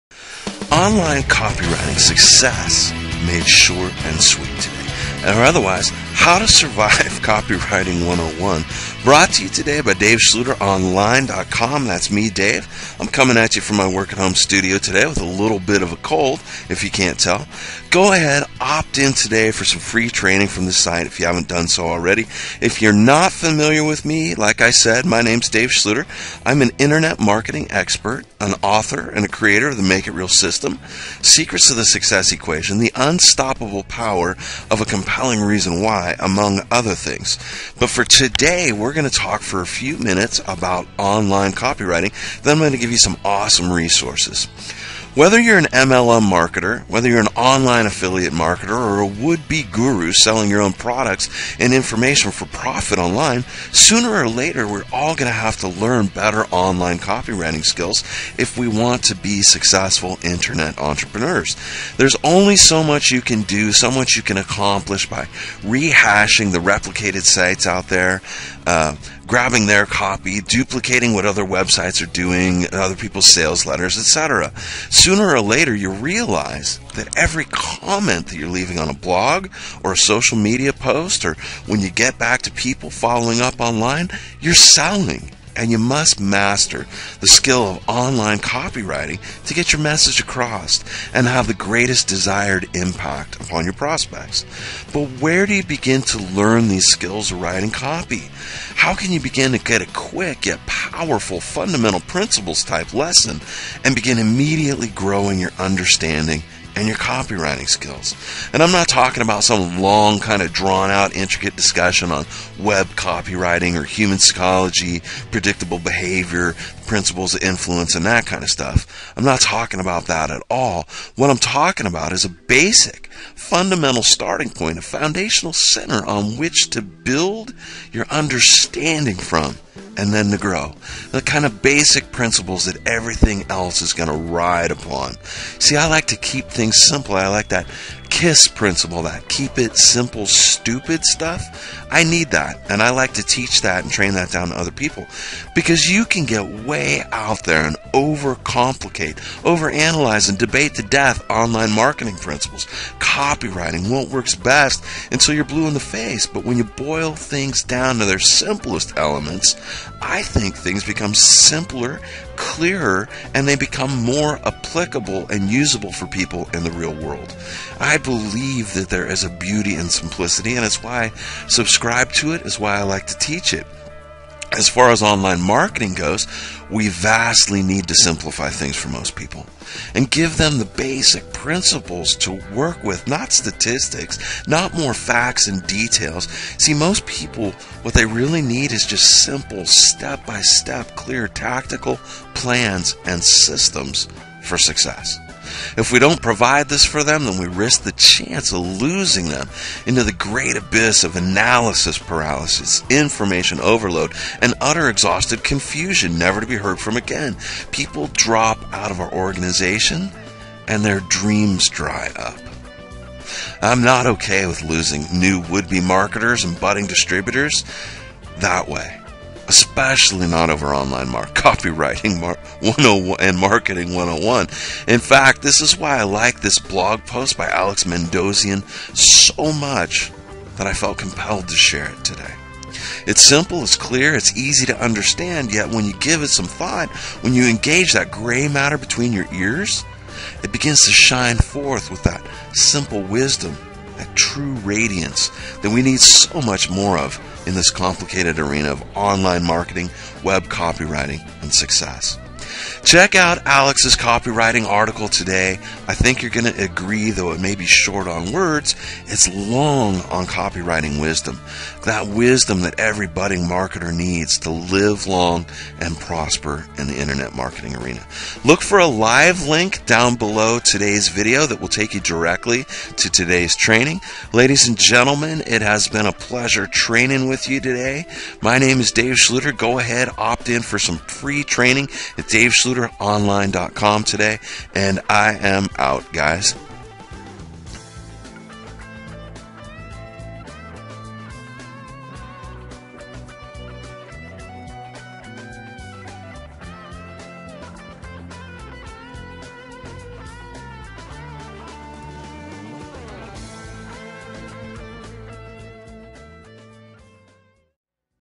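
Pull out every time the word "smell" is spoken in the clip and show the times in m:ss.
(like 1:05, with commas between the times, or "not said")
not said.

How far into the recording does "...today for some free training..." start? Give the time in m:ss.
0:19.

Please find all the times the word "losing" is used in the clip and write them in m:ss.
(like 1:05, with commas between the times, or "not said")
3:18, 3:34.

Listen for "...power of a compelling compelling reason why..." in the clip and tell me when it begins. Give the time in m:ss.
0:33.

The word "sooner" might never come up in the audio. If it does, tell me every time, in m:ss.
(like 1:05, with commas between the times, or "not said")
0:53, 1:14.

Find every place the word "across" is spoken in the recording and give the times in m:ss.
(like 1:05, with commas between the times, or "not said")
1:30.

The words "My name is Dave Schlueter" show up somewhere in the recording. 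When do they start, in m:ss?
4:38.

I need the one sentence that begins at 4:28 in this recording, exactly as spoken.
Look for a live link down below today's video that will take you directly to today's training.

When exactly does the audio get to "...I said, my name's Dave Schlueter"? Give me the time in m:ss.
0:24.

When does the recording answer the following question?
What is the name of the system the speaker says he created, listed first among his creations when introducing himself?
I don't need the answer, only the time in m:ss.
0:29.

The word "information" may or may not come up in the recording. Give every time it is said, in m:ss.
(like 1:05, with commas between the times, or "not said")
0:51, 3:22.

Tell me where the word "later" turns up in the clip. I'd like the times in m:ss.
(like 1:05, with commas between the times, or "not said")
0:54, 1:15.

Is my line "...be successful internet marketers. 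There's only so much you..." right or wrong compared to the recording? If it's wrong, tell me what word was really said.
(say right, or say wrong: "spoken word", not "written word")
wrong: "entrepreneurs", not "marketers".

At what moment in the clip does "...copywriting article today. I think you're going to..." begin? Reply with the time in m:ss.
4:13.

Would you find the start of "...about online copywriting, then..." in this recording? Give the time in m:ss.
0:40.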